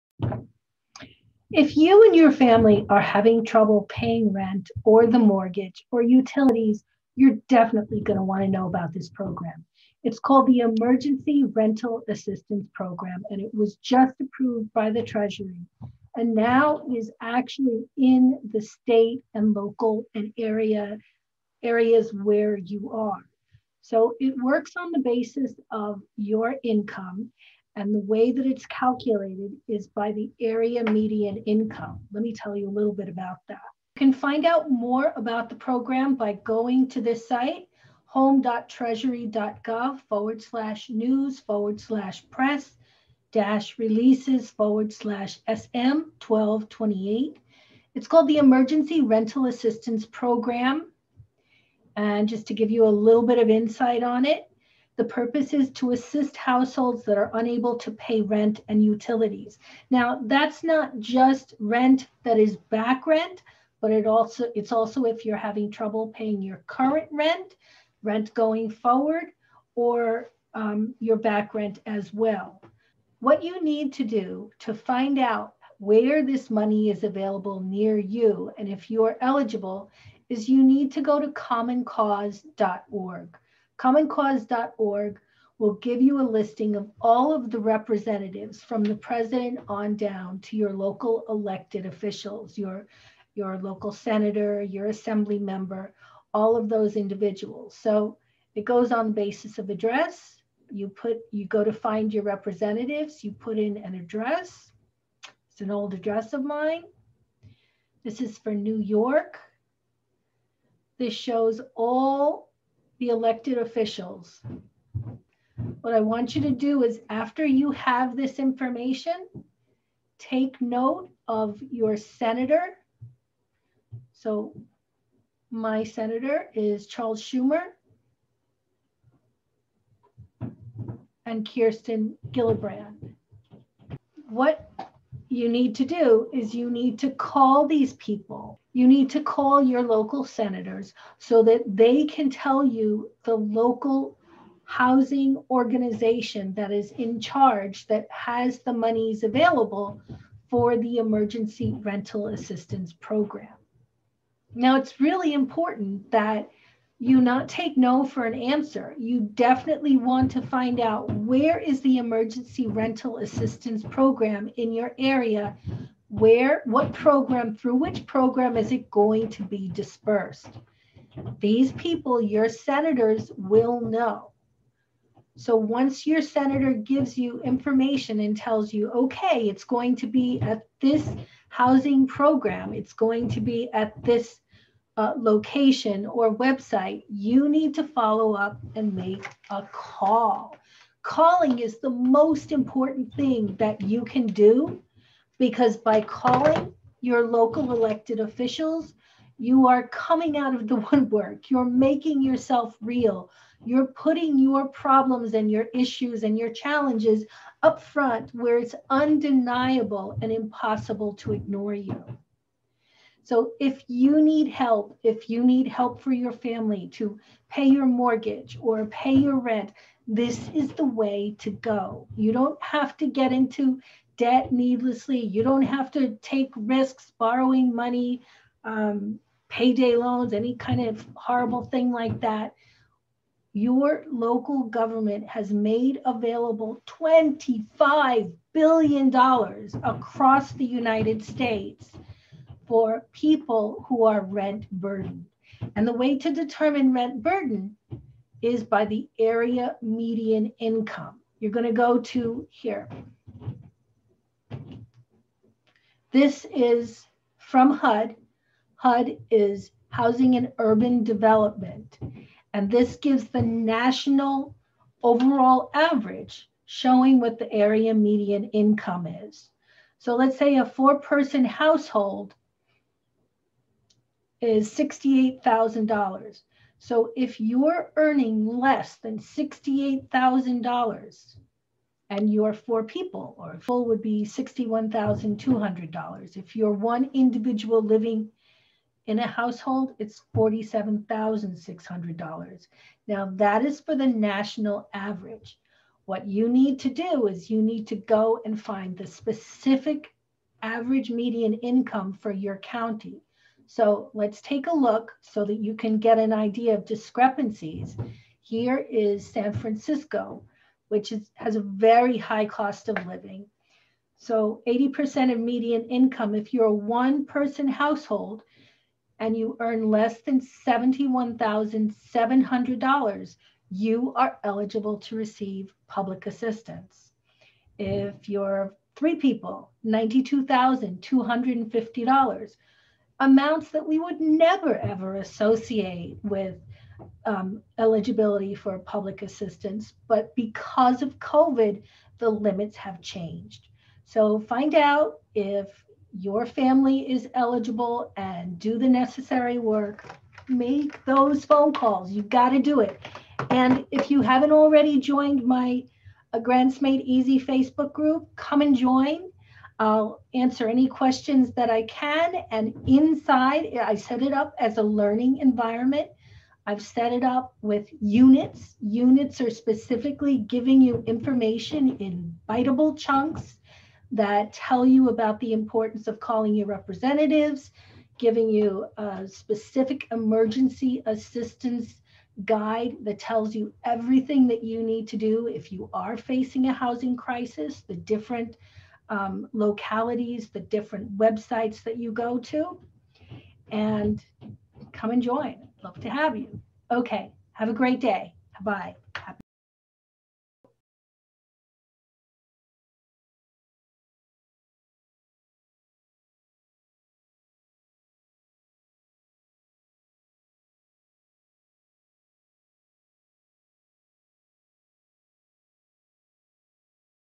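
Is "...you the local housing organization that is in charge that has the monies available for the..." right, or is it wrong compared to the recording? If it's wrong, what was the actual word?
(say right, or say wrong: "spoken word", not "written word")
right.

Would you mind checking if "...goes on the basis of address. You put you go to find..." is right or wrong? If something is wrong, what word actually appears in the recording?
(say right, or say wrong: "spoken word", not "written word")
right.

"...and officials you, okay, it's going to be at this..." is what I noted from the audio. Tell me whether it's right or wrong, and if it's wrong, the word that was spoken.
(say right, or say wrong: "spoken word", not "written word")
wrong: "tells", not "officials".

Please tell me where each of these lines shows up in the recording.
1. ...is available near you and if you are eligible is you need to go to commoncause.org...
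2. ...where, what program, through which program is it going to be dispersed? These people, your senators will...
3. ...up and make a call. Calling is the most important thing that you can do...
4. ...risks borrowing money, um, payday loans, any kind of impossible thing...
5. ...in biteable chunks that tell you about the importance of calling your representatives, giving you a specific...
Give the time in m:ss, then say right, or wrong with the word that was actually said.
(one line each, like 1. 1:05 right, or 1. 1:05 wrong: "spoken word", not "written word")
1. 1:16 right
2. 2:46 right
3. 3:08 right
4. 3:46 wrong: "horrible", not "impossible"
5. 6:11 right.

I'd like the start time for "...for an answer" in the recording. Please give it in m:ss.
2:38.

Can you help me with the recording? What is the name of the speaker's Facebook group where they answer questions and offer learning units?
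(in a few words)
Grants Made Easy.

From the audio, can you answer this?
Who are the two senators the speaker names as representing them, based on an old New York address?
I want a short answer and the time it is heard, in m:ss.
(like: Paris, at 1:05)
Charles Schumer and Kirsten Gillibrand, at 2:06.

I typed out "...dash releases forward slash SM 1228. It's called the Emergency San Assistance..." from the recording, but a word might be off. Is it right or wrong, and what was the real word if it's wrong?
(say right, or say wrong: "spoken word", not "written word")
wrong: "Rental", not "San".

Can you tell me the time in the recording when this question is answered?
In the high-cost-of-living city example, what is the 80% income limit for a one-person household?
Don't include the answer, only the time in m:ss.
5:20.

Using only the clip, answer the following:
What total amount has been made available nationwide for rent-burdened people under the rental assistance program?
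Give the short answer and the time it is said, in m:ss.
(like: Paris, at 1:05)
$25 billion, at 3:56.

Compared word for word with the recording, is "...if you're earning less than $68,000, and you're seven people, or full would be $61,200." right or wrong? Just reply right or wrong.
wrong.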